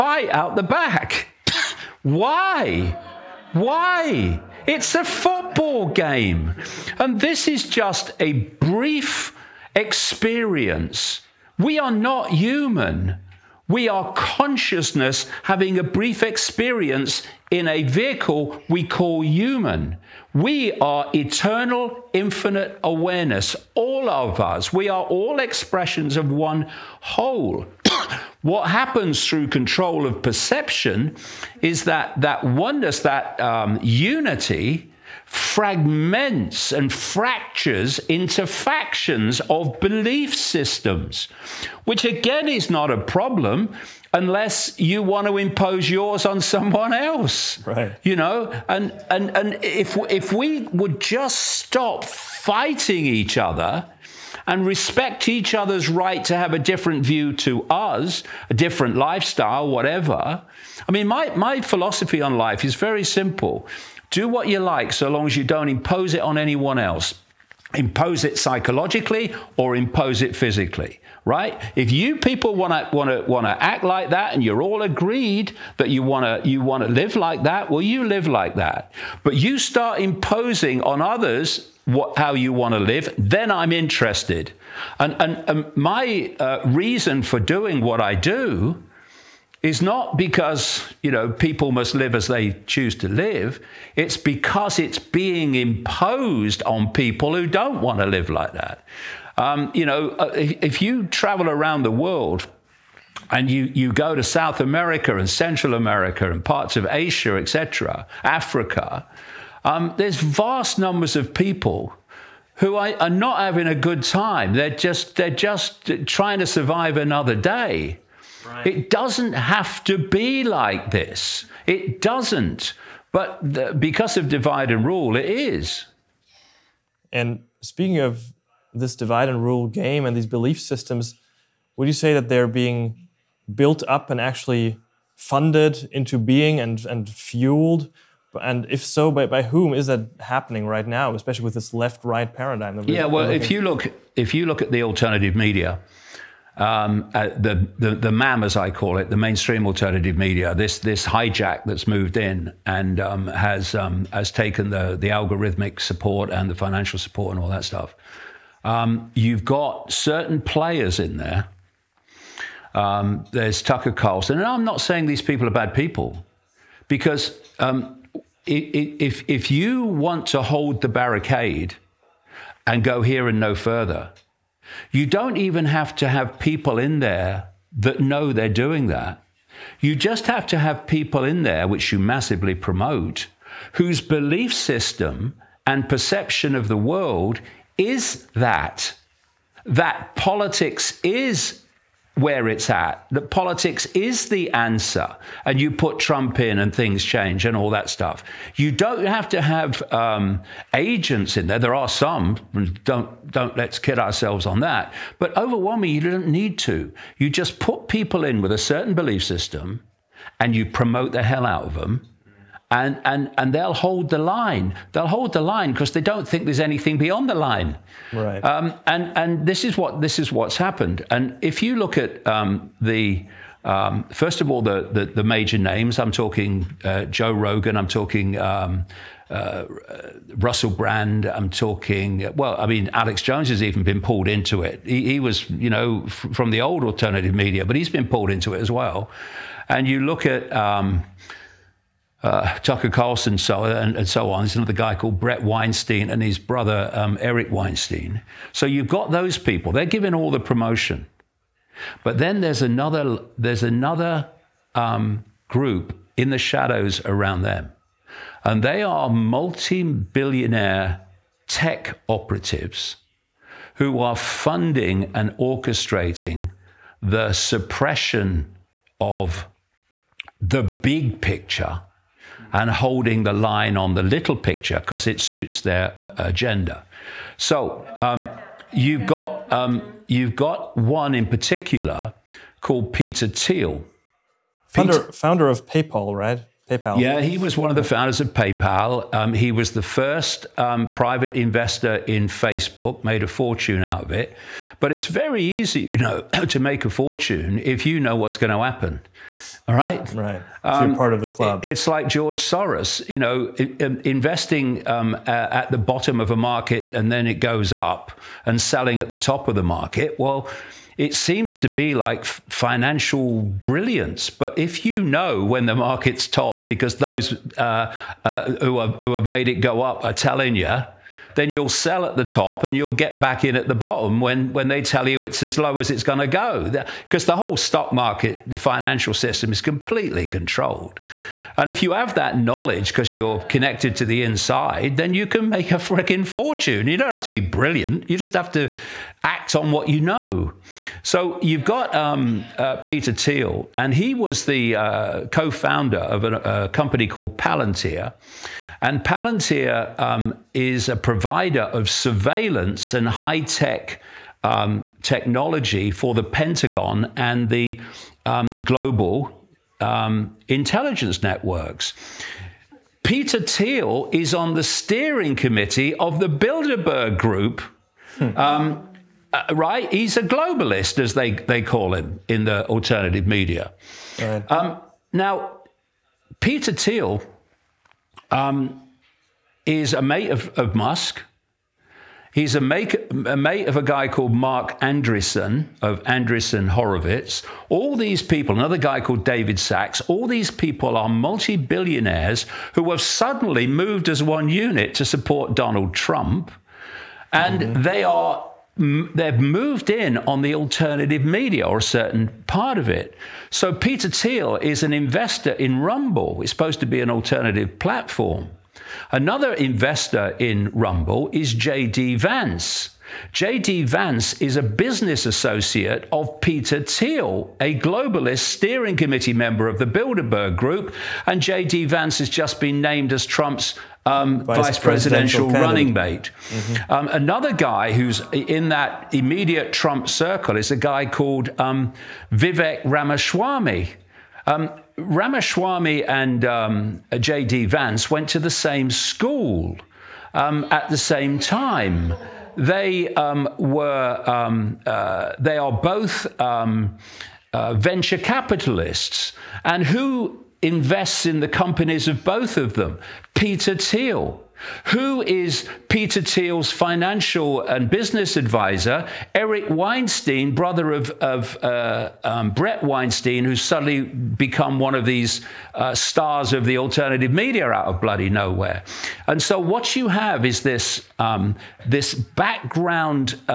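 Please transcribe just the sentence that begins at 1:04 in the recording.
Do what you like so long as you don't impose it on anyone else.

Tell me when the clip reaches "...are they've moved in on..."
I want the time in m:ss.
6:38.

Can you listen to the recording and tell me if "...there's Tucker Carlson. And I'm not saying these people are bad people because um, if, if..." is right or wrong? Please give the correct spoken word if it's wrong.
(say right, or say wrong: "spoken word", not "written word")
right.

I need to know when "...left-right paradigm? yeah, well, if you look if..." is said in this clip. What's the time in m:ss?
2:21.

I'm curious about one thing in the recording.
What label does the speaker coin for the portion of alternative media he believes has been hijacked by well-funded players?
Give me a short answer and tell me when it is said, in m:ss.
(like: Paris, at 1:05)
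mainstream alternative media, at 2:29.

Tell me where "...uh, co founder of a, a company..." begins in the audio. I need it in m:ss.
5:44.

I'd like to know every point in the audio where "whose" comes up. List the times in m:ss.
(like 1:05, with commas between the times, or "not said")
3:03.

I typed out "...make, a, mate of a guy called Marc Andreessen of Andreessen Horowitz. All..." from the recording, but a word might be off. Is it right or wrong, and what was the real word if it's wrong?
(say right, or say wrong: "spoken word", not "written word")
right.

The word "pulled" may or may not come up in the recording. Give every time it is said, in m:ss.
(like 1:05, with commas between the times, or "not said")
3:53, 3:58.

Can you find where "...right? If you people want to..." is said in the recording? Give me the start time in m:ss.
1:11.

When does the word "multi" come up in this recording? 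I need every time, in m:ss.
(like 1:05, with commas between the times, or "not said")
4:19, 6:31.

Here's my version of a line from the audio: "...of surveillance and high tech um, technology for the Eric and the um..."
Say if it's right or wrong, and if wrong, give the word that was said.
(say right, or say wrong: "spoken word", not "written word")
wrong: "Pentagon", not "Eric".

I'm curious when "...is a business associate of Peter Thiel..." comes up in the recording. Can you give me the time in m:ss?
6:54.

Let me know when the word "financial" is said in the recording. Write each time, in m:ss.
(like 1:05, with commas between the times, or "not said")
2:36, 5:12, 5:28, 7:36.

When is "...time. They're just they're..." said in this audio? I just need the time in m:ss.
1:54.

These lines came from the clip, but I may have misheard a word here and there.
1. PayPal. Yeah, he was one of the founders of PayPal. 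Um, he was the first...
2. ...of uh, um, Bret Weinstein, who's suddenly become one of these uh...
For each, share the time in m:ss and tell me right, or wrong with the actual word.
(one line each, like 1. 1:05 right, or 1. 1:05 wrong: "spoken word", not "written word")
1. 4:46 right
2. 7:41 right.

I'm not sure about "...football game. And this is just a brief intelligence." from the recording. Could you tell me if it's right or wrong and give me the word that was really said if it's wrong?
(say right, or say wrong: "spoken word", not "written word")
wrong: "experience", not "intelligence".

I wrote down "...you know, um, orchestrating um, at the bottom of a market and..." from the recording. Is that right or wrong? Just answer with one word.
wrong.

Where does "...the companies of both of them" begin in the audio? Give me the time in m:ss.
7:31.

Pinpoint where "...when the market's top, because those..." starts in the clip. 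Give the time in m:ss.
5:15.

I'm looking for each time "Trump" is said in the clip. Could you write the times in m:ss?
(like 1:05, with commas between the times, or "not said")
3:15, 6:35, 7:03, 7:09.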